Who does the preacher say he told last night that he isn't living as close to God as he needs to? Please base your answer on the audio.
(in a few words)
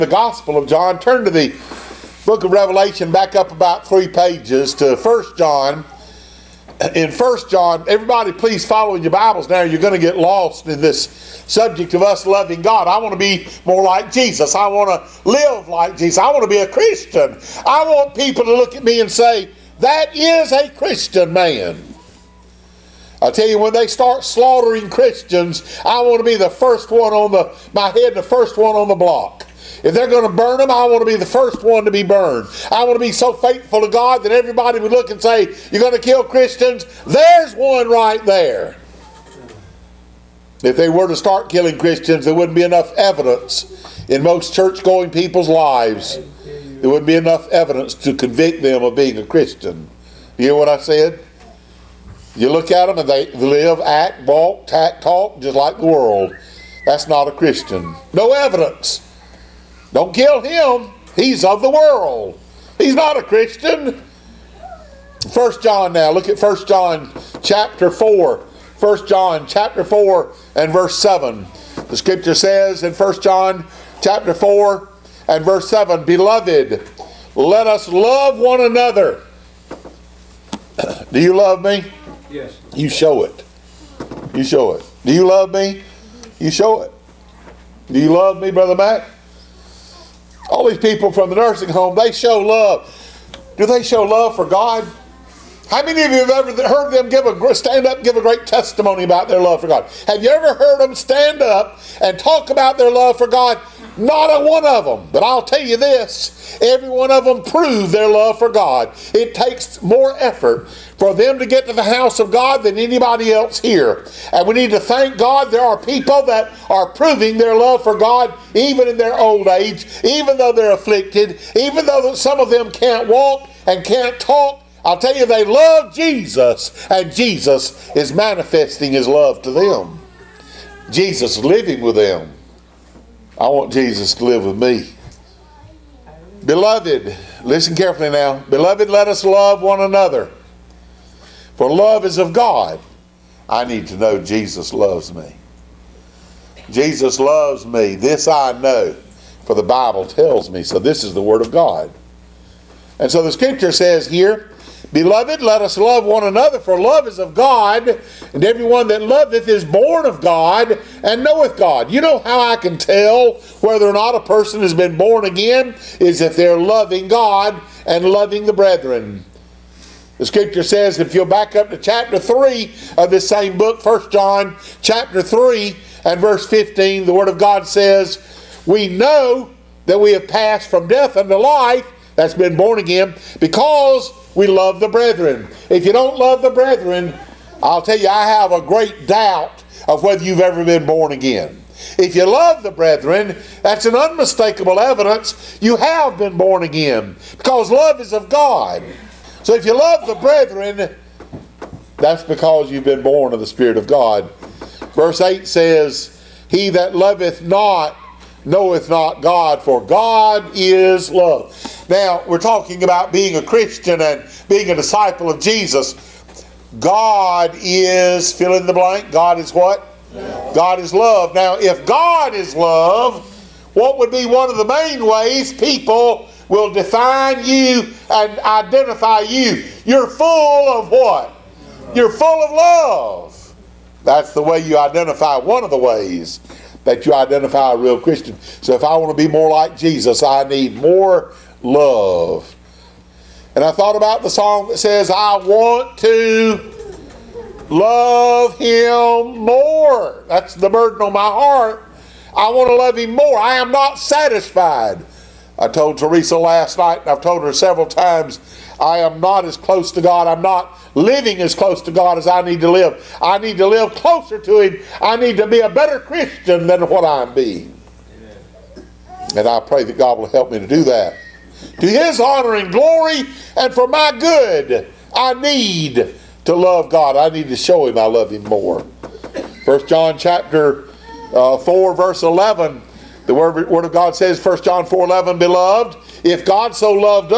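Teresa.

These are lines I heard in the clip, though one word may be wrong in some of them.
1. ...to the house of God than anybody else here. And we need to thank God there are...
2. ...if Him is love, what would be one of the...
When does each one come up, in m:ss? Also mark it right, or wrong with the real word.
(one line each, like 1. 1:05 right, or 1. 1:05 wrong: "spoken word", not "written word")
1. 1:51 right
2. 3:41 wrong: "God", not "Him".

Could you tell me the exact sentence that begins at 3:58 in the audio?
So if I want to be more like Jesus, I need more love.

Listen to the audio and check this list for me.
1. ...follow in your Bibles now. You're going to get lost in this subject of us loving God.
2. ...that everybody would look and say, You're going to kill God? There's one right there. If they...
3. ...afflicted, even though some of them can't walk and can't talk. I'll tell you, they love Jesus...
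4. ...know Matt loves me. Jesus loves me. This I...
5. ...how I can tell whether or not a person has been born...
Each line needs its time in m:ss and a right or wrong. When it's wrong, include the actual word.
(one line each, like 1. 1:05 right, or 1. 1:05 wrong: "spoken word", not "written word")
1. 0:08 right
2. 0:34 wrong: "Christians", not "God"
3. 2:00 right
4. 2:23 wrong: "Jesus", not "Matt"
5. 2:42 right.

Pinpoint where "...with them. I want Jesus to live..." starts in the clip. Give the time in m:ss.
2:11.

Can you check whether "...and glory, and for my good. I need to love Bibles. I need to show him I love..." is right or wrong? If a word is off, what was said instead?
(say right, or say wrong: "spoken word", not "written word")
wrong: "God", not "Bibles".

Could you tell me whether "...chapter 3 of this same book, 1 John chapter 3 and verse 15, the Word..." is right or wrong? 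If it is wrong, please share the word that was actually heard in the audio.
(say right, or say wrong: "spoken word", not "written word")
right.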